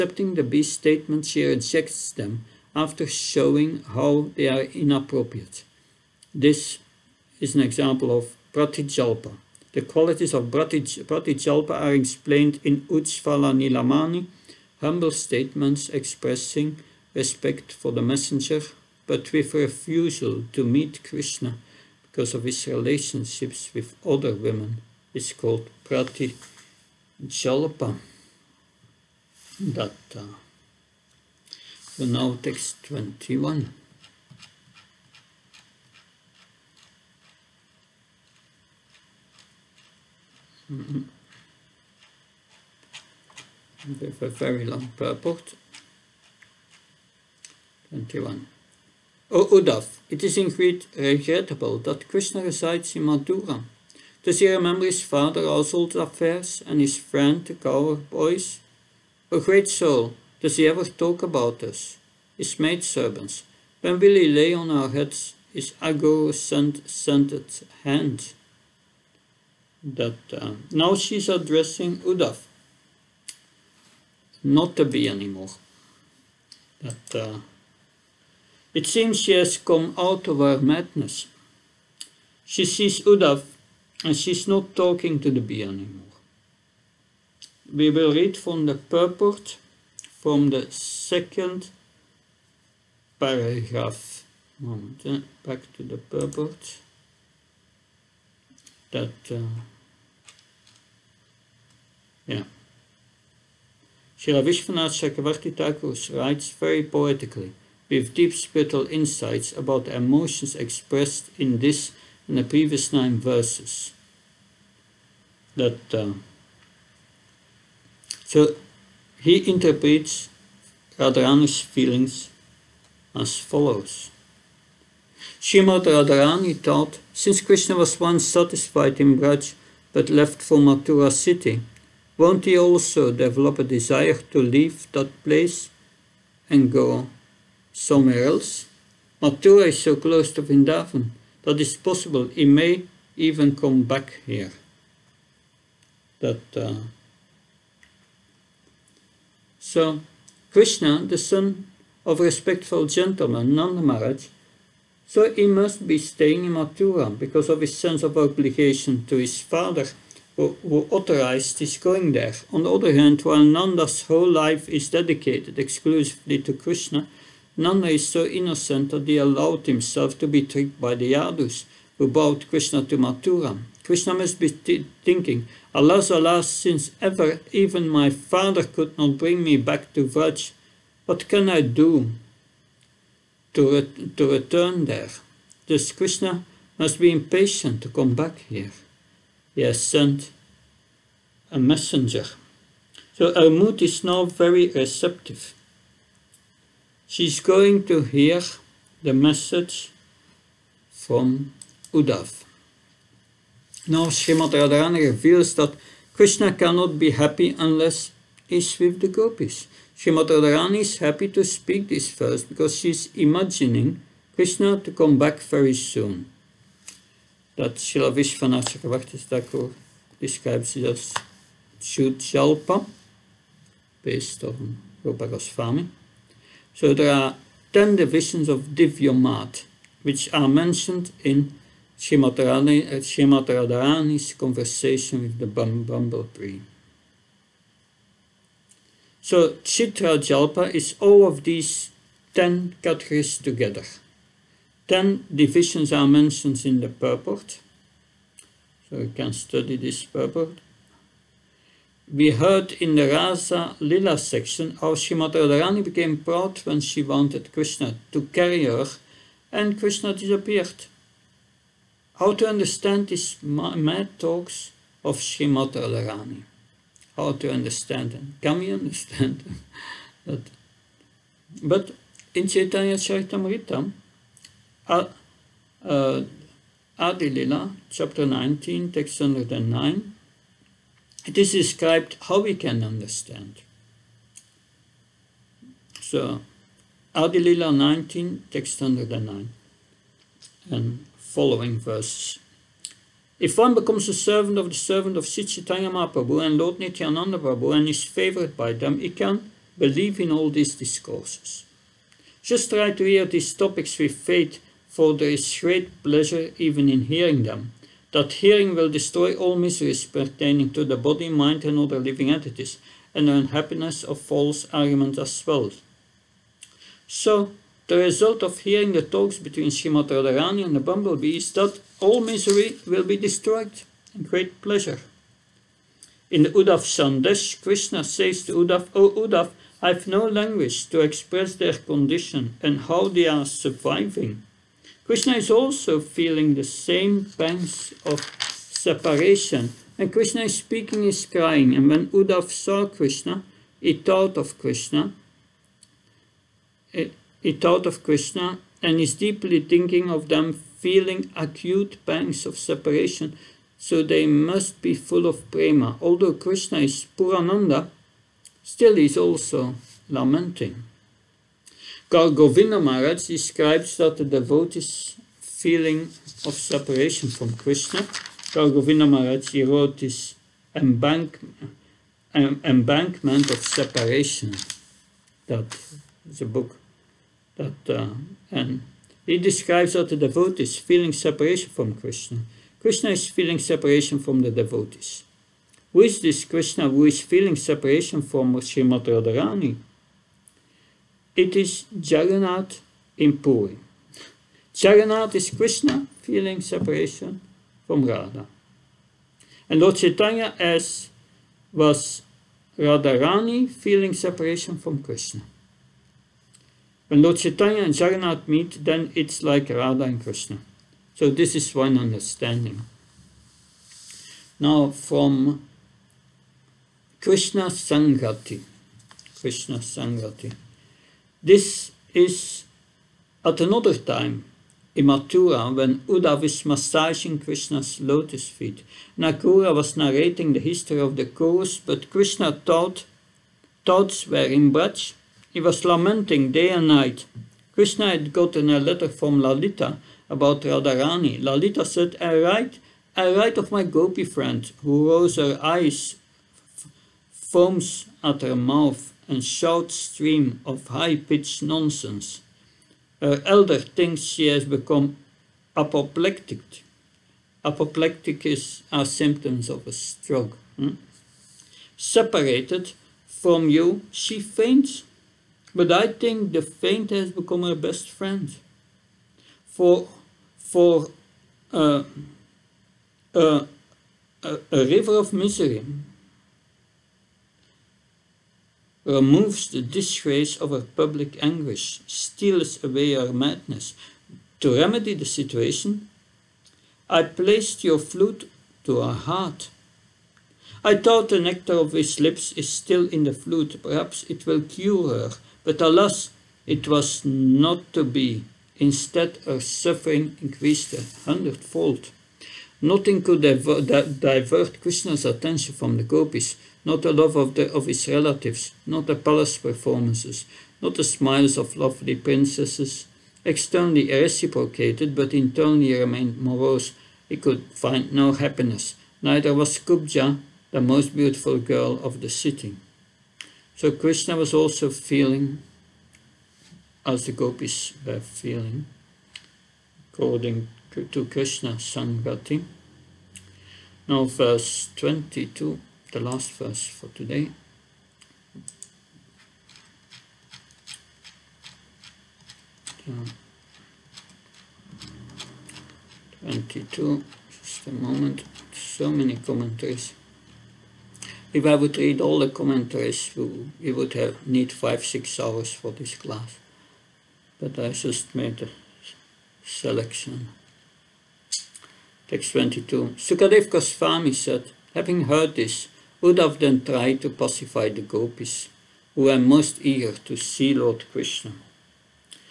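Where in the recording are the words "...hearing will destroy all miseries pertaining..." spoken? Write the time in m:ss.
5:08.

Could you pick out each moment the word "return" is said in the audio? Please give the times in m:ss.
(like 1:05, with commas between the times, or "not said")
3:04.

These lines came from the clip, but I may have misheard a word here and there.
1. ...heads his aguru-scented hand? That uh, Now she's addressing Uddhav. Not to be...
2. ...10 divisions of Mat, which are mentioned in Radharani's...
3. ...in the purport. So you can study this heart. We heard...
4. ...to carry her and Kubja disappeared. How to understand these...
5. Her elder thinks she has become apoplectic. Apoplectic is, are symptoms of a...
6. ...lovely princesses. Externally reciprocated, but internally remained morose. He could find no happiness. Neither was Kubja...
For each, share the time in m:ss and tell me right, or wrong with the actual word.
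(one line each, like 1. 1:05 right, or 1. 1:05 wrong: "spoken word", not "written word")
1. 1:04 right
2. 3:47 right
3. 4:06 wrong: "purport", not "heart"
4. 4:18 wrong: "Krishna", not "Kubja"
5. 7:33 right
6. 8:31 right.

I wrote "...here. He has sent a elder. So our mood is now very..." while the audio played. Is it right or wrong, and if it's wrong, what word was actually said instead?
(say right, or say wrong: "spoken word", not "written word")
wrong: "messenger", not "elder".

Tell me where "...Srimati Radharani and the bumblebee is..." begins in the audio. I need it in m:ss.
5:19.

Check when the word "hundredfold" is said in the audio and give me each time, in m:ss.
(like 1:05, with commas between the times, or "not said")
8:21.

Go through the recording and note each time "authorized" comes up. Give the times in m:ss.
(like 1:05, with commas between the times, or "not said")
2:40.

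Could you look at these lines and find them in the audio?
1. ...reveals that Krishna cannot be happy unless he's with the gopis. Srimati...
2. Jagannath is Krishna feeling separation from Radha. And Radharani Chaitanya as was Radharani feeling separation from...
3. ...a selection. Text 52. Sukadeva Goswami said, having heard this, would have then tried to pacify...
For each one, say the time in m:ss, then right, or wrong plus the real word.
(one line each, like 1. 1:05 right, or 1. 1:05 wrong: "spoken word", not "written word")
1. 3:25 right
2. 6:34 wrong: "Lord", not "Radharani"
3. 9:18 wrong: "22", not "52".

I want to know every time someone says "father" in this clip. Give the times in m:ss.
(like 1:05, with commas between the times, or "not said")
0:55, 2:39, 2:58.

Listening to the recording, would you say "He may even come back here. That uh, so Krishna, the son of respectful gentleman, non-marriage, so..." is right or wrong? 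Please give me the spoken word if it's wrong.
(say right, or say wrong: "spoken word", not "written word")
right.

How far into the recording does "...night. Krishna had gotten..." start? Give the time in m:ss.
7:16.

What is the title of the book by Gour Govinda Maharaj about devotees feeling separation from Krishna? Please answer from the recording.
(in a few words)
Embankment of Separation.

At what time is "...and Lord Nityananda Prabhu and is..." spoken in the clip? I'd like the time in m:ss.
4:56.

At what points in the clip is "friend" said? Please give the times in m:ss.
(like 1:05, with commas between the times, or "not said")
0:56, 7:24, 7:48.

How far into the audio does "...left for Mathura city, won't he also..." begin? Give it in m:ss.
2:10.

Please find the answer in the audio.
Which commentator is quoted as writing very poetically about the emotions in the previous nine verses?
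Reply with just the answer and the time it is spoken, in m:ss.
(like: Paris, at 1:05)
Srila Vishwanath Chakravarti Thakur, at 1:44.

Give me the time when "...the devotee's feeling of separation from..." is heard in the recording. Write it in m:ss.
6:04.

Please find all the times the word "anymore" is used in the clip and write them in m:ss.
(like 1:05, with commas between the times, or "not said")
1:15, 1:25.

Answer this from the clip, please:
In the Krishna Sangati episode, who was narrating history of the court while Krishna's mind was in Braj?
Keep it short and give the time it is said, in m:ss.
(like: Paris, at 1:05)
Nakula, at 7:09.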